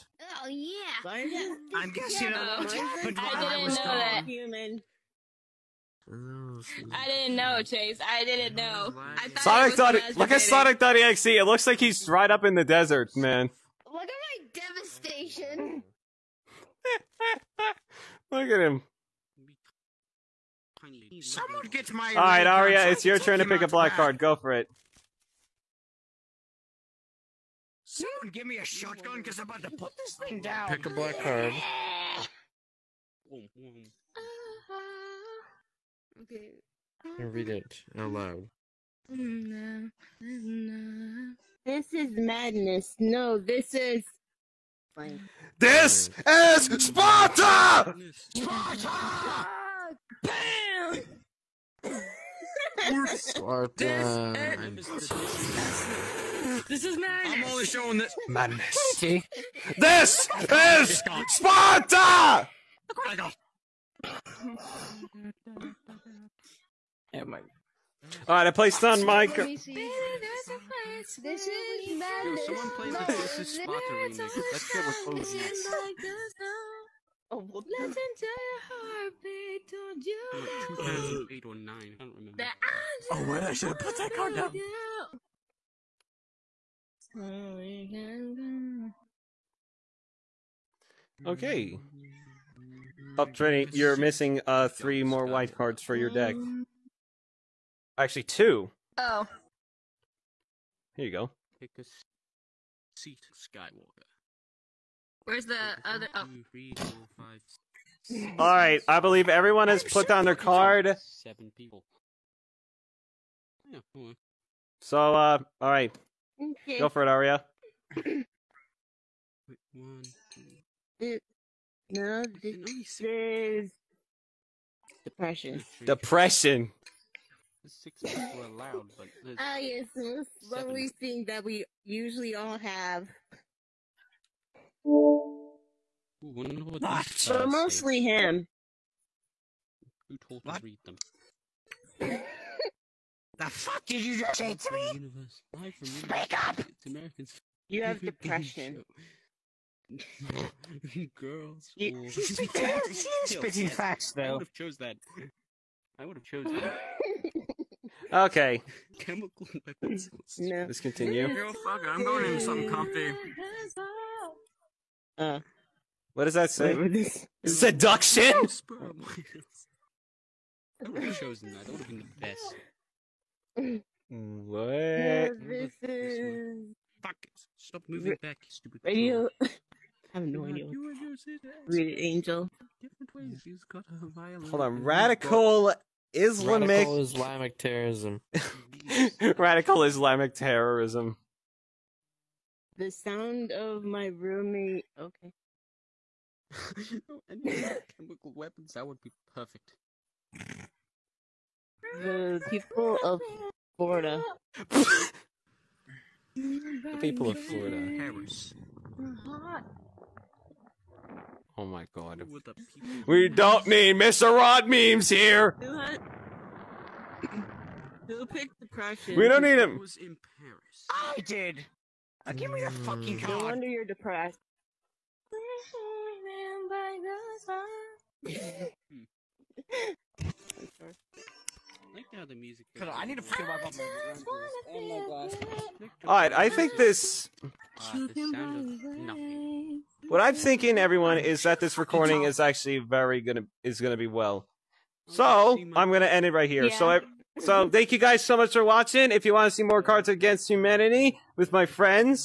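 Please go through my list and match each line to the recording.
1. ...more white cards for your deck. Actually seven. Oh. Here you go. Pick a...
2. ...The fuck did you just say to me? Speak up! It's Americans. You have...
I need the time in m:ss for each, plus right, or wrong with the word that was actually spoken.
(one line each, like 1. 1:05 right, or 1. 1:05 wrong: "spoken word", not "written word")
1. 1:35 wrong: "two", not "seven"
2. 2:23 right.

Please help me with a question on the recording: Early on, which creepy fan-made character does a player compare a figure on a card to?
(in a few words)
Sonic.exe.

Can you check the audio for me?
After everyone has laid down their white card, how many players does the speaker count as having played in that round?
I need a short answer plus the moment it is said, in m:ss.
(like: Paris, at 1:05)
7, at 1:50.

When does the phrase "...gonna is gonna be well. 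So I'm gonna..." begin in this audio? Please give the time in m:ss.
4:03.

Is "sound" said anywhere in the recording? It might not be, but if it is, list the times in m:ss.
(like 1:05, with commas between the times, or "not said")
3:12, 3:57.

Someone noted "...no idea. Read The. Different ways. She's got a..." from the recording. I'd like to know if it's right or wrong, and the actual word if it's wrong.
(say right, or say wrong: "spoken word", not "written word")
wrong: "Angel", not "The".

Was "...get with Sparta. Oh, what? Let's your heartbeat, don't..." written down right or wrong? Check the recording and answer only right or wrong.
wrong.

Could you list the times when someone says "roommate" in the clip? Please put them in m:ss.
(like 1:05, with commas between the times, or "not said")
3:14.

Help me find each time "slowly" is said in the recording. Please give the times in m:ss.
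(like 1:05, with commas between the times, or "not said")
2:10.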